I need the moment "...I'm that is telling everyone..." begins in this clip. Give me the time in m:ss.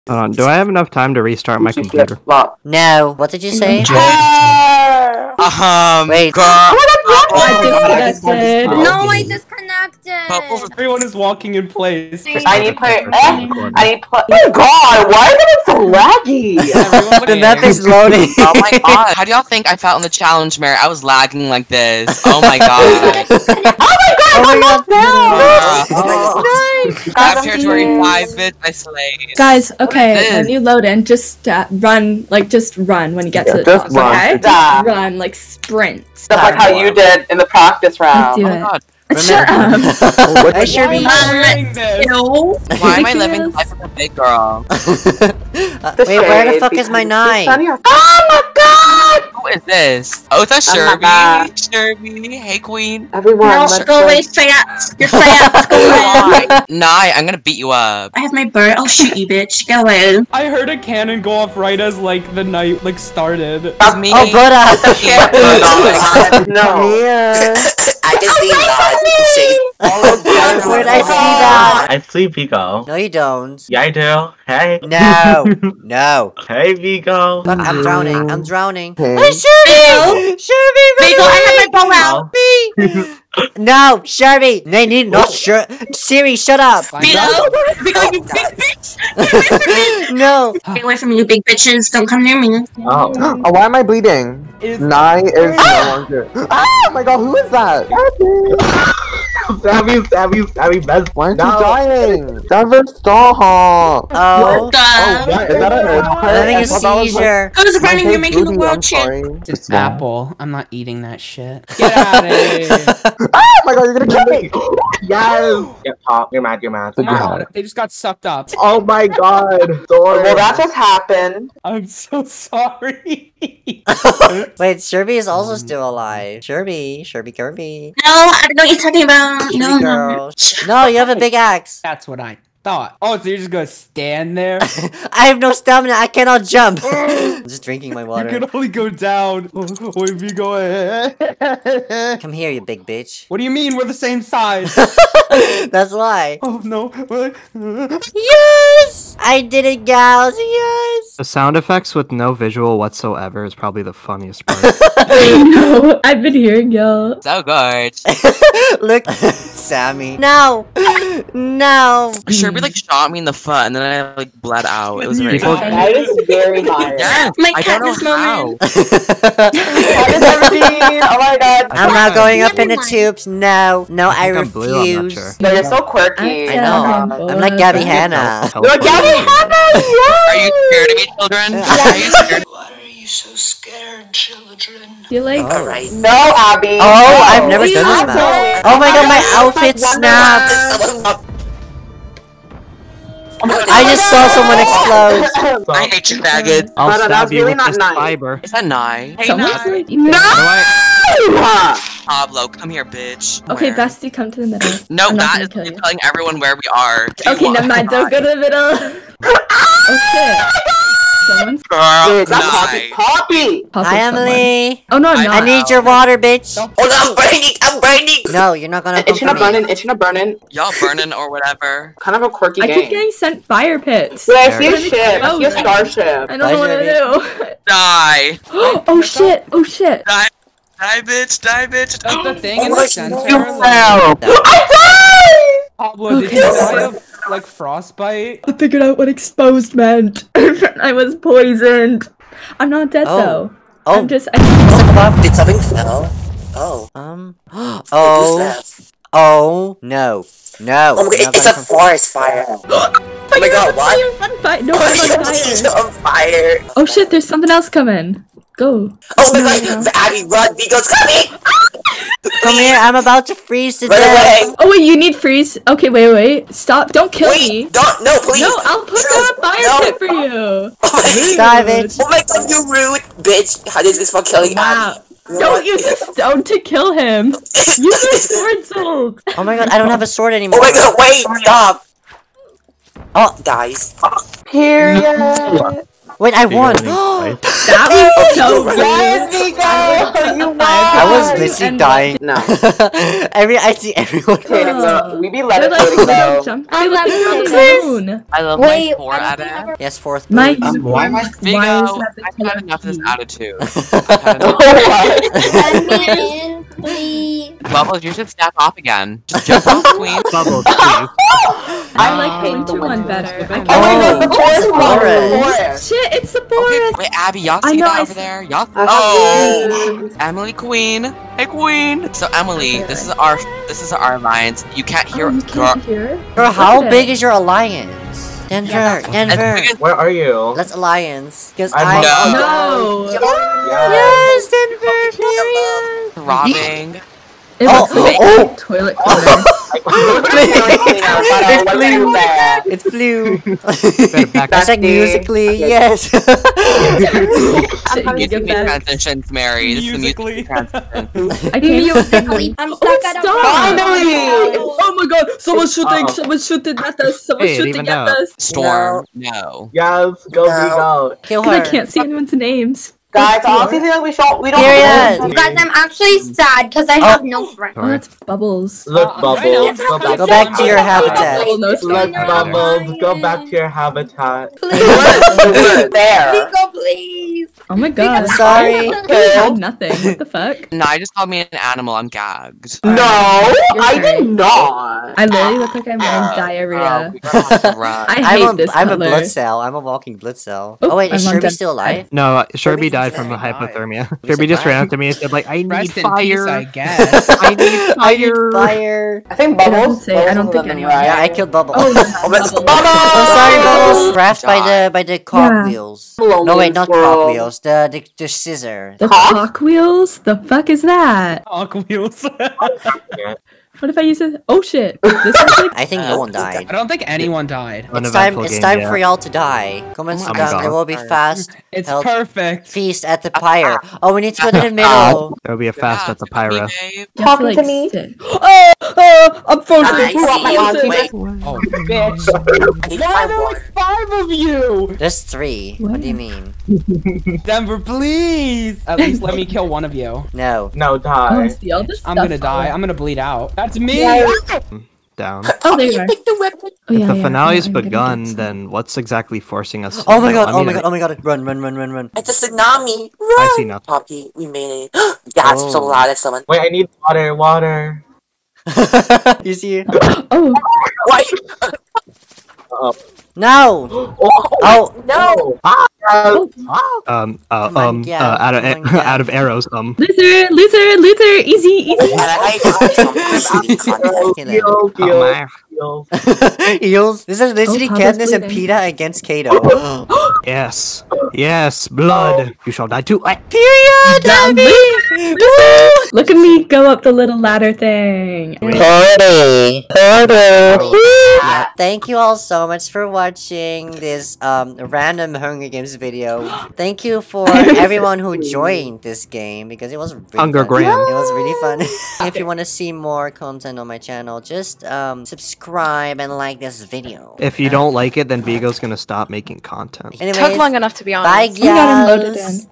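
3:25.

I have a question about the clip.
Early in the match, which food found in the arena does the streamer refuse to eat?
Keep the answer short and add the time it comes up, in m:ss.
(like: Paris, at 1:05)
apple, at 1:49.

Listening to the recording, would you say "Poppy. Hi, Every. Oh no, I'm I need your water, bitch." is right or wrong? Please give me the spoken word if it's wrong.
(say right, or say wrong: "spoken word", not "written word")
wrong: "Emily", not "Every".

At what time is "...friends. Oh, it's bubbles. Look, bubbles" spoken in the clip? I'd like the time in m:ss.
6:07.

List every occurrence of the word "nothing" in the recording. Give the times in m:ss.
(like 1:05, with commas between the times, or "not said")
6:19, 7:33.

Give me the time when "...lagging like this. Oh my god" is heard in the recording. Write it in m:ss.
0:21.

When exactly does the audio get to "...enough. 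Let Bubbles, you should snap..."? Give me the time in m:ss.
5:05.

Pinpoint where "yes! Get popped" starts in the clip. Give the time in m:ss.
1:55.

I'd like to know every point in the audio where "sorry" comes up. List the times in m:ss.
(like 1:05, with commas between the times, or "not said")
2:02, 6:18, 6:43.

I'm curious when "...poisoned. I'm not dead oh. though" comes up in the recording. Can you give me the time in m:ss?
4:01.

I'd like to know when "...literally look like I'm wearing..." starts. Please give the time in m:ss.
6:25.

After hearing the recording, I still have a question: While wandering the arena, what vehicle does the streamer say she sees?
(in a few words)
a starship.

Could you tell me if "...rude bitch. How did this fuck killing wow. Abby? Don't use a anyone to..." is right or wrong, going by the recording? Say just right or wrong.
wrong.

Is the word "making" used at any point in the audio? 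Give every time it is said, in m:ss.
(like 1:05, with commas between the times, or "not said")
1:48, 8:29.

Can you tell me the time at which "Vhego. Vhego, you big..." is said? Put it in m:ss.
1:26.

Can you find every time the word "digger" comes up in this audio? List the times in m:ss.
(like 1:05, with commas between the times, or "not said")
not said.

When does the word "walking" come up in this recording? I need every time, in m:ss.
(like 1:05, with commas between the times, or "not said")
0:11, 6:29.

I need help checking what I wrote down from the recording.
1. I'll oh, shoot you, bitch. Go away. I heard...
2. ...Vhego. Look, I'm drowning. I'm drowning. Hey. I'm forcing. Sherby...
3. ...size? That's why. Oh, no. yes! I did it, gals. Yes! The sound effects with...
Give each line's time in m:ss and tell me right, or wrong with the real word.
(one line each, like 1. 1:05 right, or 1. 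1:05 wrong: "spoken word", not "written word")
1. 0:58 right
2. 1:16 wrong: "shooting", not "forcing"
3. 2:24 right.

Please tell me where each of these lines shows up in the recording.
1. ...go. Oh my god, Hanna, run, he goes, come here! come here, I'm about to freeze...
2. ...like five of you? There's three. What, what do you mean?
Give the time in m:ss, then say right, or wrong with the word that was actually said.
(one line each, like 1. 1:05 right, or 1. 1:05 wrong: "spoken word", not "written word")
1. 4:18 wrong: "Abby", not "Hanna"
2. 7:13 right.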